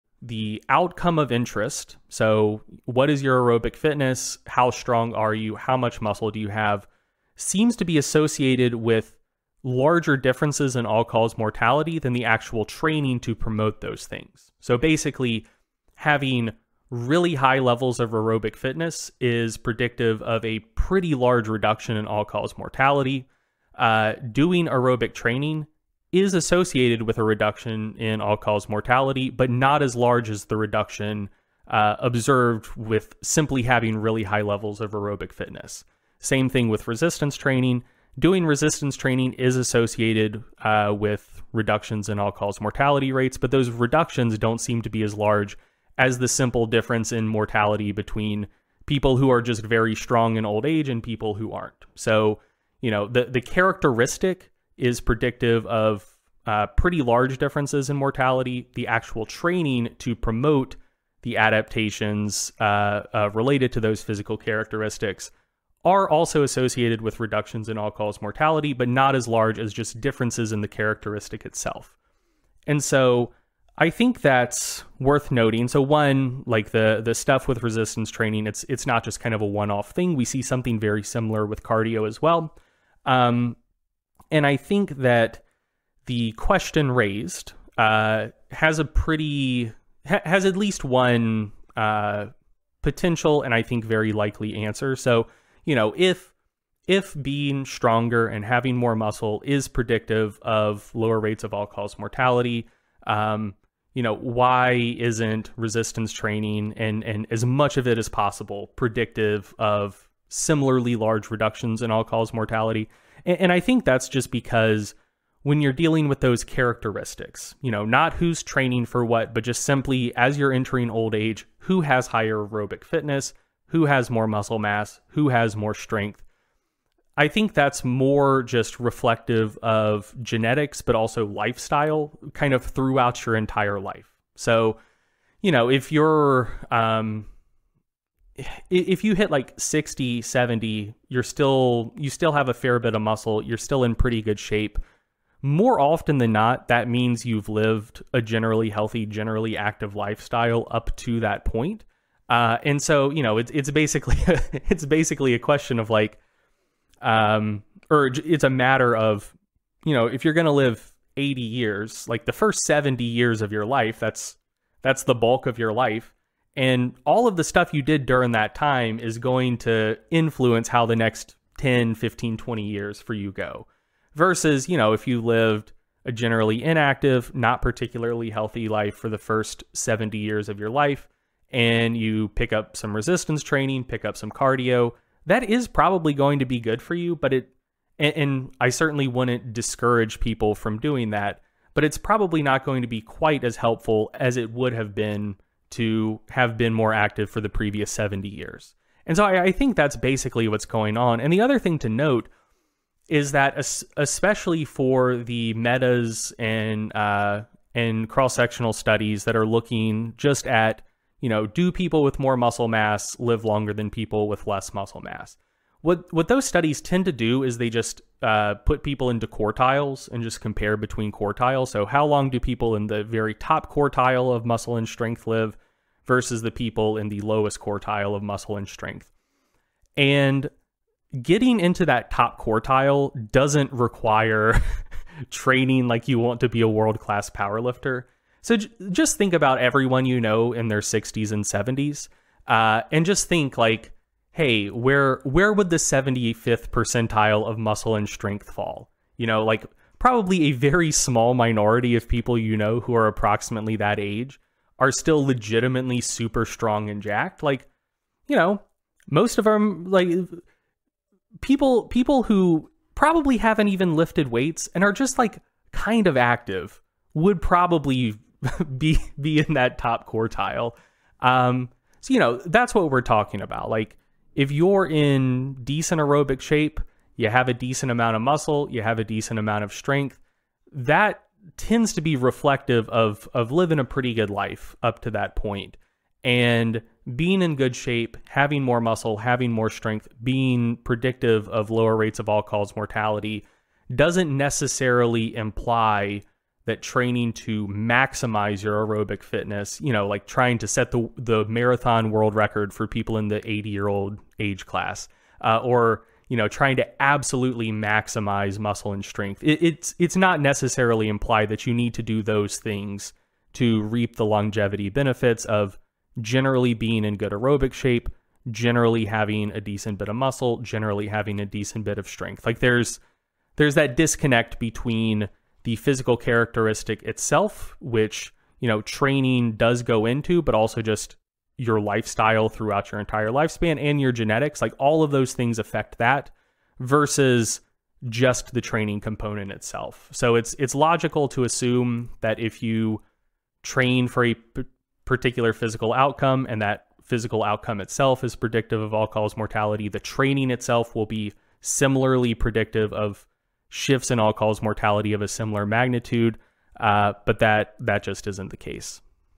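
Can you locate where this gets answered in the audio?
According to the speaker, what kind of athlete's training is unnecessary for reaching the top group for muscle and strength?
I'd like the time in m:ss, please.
3:56.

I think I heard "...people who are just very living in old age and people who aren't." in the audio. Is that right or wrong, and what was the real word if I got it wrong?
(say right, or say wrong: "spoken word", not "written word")
wrong: "strong", not "living".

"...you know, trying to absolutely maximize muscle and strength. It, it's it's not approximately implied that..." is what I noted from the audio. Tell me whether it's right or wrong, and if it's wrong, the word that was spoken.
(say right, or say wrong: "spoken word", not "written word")
wrong: "necessarily", not "approximately".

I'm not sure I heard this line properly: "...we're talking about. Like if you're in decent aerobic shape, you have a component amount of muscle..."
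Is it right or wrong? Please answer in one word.
wrong.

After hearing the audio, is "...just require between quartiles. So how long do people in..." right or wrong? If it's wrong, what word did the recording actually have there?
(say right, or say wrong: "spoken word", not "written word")
wrong: "compare", not "require".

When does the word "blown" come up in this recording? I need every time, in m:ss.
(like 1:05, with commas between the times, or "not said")
not said.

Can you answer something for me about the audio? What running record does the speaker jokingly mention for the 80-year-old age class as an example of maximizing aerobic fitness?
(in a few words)
marathon world record.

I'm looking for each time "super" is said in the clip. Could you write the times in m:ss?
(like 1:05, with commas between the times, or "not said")
4:16.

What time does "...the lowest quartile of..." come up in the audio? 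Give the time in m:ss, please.
3:47.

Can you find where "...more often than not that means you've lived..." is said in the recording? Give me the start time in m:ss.
2:25.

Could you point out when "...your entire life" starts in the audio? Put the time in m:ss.
2:13.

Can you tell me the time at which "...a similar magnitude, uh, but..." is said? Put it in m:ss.
5:55.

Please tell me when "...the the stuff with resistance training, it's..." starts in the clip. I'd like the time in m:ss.
1:16.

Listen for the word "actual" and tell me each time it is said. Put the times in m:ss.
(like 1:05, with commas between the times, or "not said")
0:12, 0:58.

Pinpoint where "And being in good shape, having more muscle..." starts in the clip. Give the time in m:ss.
4:46.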